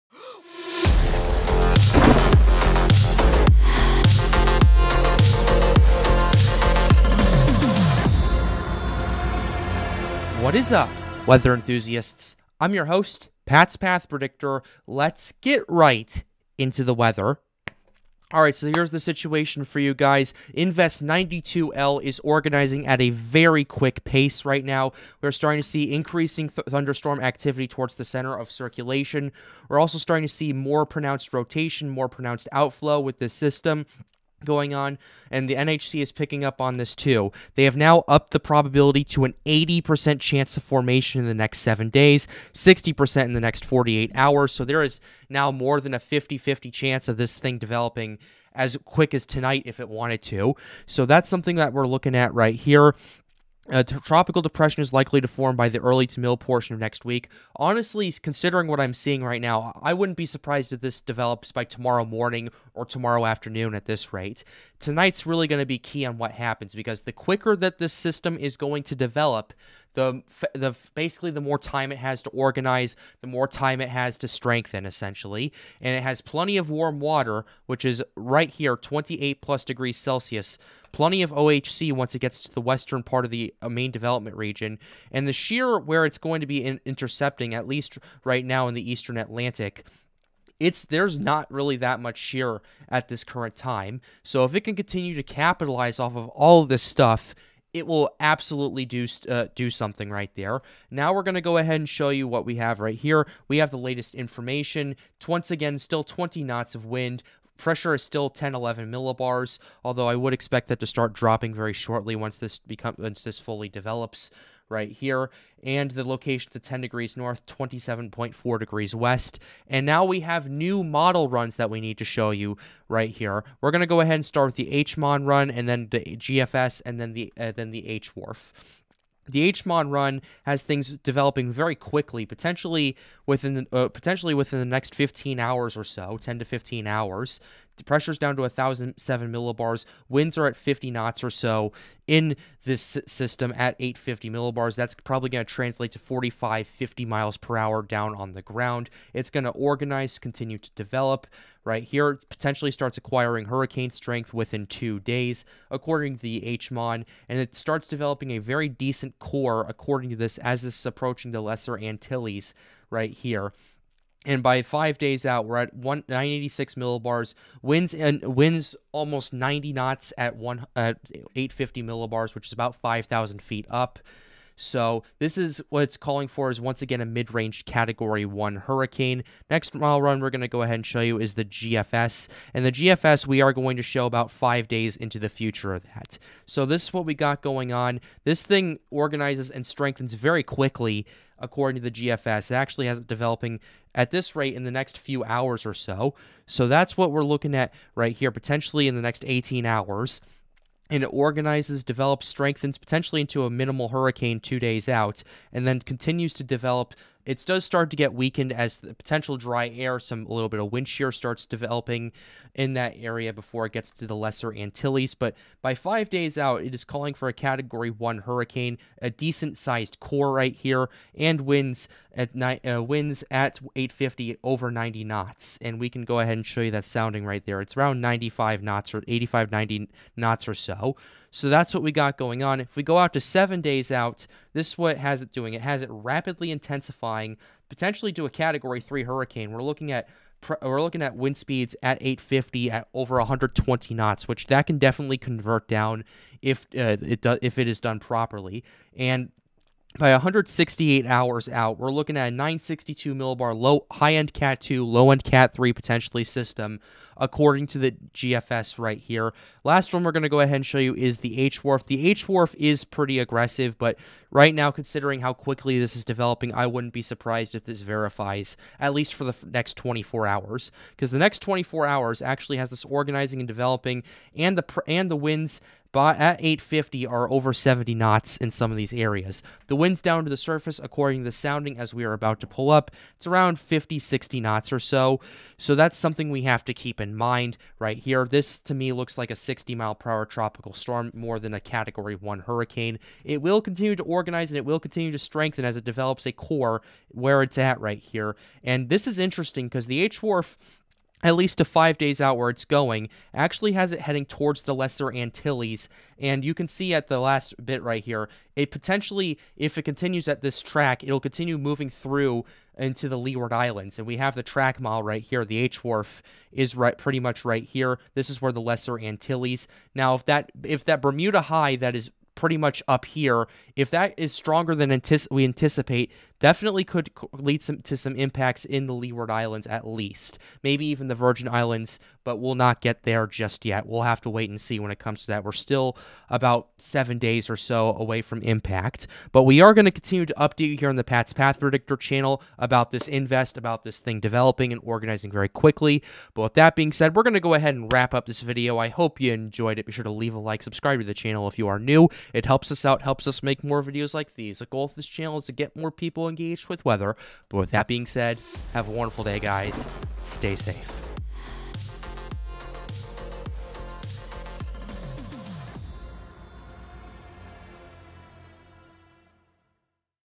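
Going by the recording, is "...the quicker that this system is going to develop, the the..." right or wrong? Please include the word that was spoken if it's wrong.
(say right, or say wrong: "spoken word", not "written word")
right.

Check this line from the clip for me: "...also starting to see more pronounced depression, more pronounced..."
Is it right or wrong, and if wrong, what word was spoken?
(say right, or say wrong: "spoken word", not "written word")
wrong: "rotation", not "depression".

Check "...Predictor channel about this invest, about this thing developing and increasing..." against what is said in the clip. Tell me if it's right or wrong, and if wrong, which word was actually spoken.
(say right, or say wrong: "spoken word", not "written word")
wrong: "organizing", not "increasing".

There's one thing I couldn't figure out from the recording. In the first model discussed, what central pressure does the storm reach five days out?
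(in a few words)
986 millibars.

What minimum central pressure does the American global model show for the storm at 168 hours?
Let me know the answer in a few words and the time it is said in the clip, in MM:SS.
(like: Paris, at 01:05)
962 millibars, at 04:12.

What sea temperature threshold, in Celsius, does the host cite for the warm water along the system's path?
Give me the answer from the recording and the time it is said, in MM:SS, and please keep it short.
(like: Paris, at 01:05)
28 degrees Celsius, at 01:18.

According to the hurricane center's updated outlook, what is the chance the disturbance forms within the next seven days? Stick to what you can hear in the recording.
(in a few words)
80%.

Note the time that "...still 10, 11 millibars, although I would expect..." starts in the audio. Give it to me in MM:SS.
01:48.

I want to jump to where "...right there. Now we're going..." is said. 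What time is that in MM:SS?
01:40.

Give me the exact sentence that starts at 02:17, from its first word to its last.
The pressure's down to 1,007 millibars.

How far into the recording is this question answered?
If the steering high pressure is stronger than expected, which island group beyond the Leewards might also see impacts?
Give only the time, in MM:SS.
05:31.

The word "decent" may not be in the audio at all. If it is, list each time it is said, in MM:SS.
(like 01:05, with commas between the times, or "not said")
02:38, 03:39.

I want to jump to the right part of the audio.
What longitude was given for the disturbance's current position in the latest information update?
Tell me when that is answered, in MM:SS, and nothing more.
01:57.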